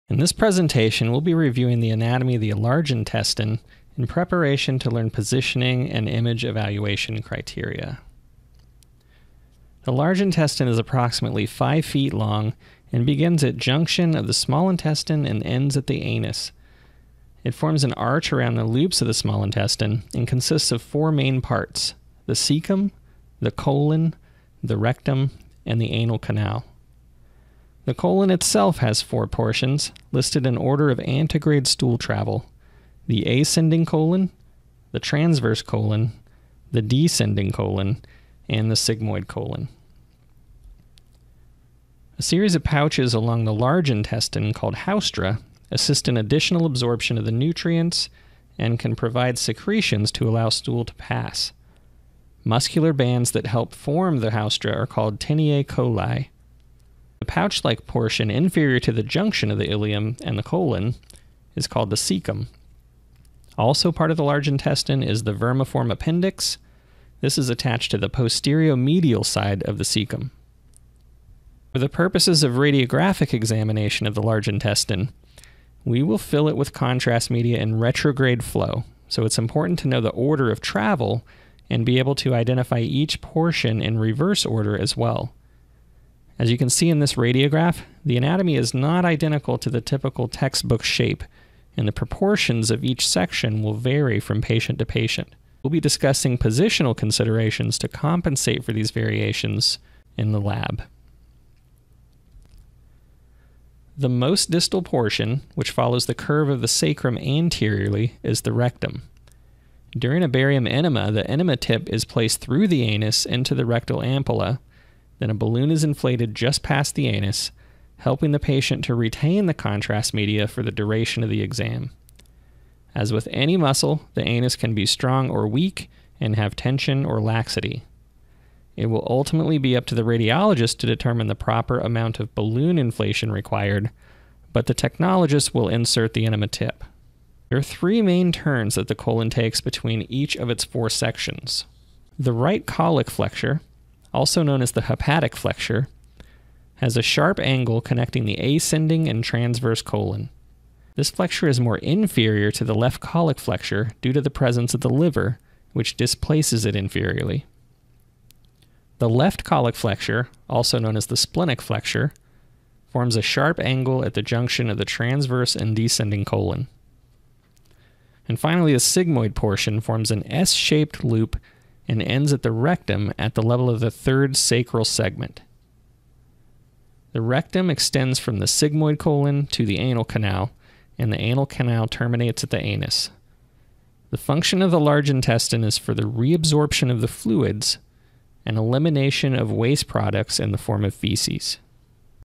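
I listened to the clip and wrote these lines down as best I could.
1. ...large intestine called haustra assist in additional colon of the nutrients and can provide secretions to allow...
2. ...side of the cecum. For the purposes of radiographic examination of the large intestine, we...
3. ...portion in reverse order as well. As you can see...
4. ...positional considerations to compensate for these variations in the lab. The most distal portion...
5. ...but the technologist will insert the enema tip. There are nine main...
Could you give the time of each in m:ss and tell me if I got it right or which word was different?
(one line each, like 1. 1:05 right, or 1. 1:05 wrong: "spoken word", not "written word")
1. 0:43 wrong: "absorption", not "colon"
2. 1:09 right
3. 1:23 right
4. 1:36 right
5. 2:14 wrong: "three", not "nine".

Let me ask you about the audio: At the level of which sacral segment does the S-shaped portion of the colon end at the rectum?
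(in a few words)
3rd.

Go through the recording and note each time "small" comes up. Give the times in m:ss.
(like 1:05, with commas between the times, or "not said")
0:14, 0:19.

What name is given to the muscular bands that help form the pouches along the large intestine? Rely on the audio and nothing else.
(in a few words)
teniae coli.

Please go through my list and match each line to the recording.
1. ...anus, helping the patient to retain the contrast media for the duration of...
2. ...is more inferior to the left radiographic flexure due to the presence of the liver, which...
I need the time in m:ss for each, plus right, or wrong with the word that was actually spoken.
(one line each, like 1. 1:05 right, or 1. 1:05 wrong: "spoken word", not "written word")
1. 1:57 right
2. 2:31 wrong: "colic", not "radiographic".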